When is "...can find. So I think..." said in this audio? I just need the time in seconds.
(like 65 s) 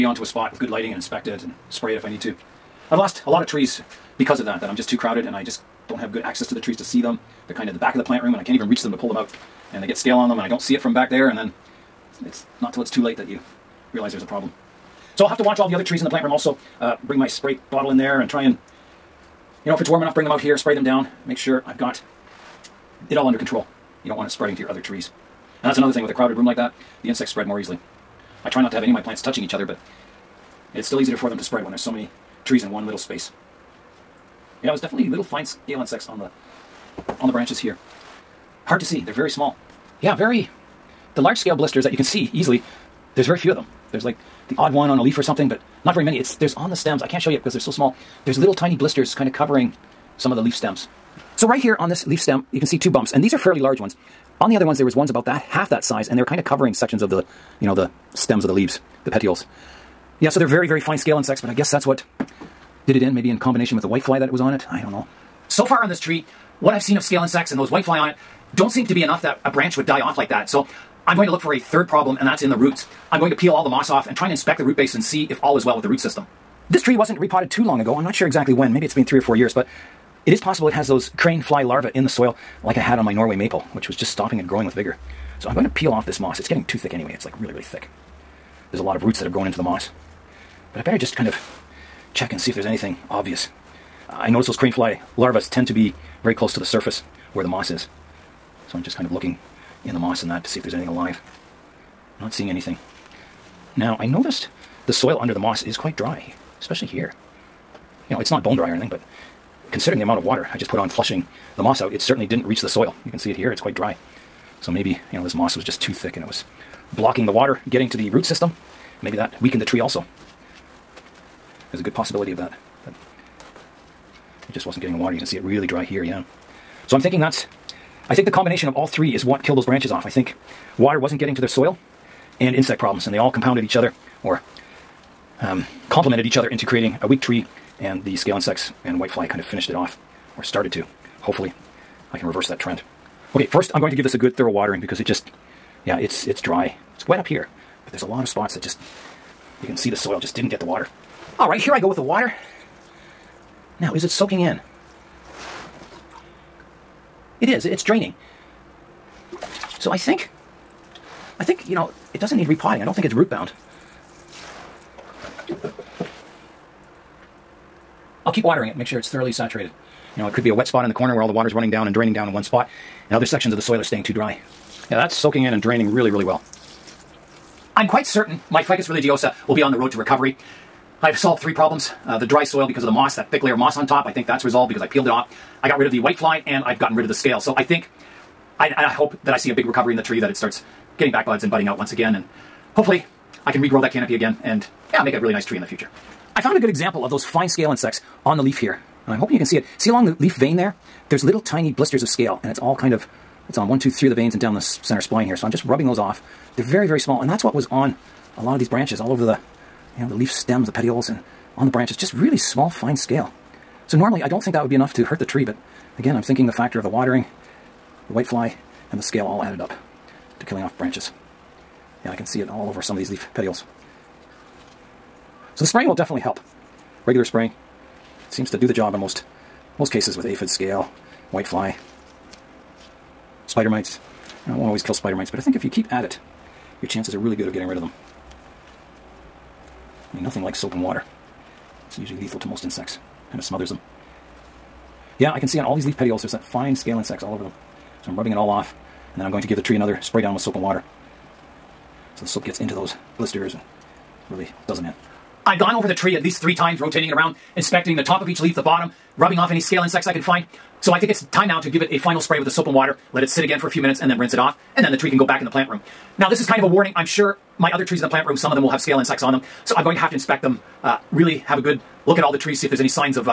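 260 s.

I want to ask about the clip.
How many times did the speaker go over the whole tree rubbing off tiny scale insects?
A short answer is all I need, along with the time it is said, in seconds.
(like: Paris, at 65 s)
At least 3 times, at 256 s.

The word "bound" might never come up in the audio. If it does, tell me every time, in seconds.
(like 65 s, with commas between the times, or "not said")
163 s.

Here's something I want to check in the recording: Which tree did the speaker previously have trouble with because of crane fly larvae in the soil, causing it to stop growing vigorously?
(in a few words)
Norway maple.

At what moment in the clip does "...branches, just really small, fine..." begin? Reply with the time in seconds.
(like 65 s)
211 s.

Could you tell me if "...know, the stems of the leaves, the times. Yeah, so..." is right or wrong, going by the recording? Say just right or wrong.
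wrong.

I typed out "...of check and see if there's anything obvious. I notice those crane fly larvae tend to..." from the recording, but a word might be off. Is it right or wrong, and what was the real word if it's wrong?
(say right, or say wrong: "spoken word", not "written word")
right.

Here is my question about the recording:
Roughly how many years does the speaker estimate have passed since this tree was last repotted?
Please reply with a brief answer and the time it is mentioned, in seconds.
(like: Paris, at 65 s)
3 or 4 years, at 79 s.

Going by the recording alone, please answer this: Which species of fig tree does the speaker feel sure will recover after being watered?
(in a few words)
Ficus religiosa.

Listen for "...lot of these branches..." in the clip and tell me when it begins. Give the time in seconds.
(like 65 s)
208 s.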